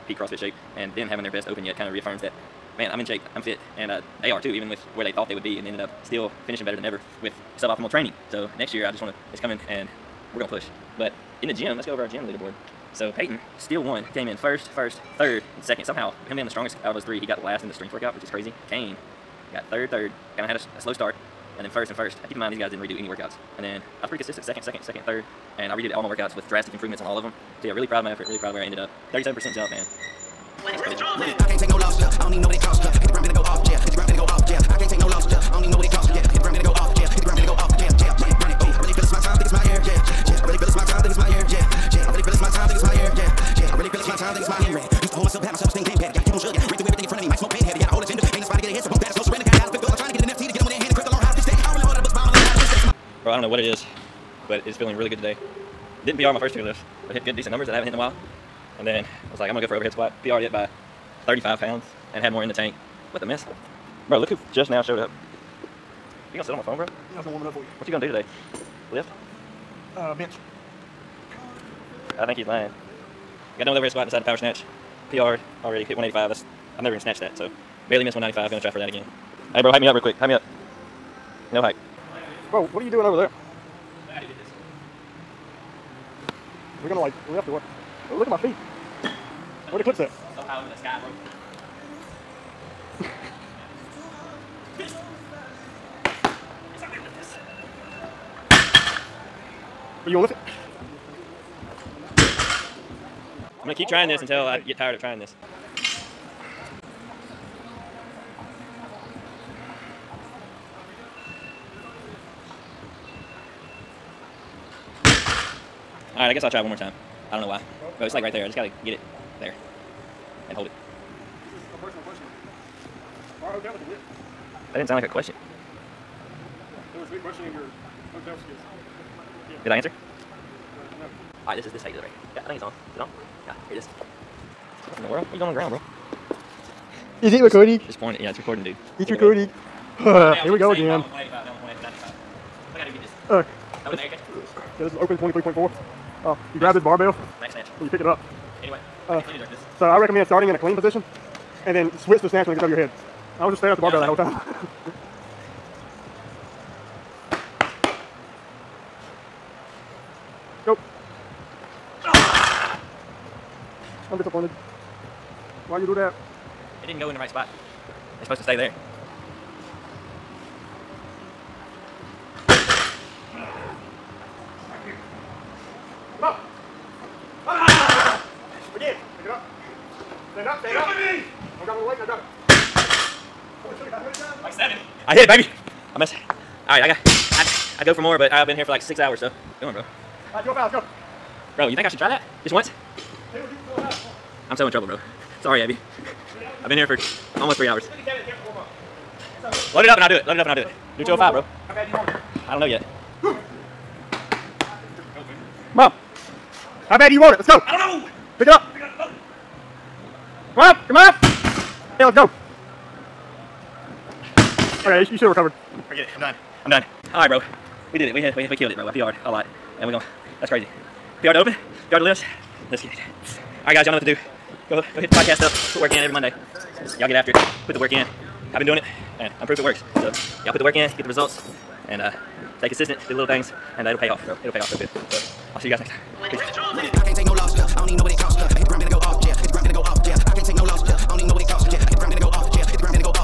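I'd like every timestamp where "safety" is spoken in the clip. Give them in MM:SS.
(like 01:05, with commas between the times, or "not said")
not said.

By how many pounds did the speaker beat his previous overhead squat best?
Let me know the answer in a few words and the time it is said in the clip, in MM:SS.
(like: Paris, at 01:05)
35 pounds, at 01:01.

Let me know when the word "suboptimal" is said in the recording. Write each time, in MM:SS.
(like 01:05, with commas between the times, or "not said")
00:07.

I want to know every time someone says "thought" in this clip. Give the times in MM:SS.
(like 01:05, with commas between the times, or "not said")
00:05.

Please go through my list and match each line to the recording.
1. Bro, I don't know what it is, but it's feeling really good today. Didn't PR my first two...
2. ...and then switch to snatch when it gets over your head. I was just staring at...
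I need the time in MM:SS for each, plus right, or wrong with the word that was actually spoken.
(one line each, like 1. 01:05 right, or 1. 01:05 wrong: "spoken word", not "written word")
1. 00:53 right
2. 02:31 right.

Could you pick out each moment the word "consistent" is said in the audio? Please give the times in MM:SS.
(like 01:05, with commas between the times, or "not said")
00:24, 03:52.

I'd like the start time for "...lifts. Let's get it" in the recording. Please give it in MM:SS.
03:42.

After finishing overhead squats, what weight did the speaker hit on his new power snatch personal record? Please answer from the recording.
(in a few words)
185.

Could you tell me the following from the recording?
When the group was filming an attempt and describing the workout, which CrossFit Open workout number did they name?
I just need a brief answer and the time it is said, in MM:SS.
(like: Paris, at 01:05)
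23.4, at 02:25.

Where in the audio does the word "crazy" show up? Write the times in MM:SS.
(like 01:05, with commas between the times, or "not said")
00:18, 03:40.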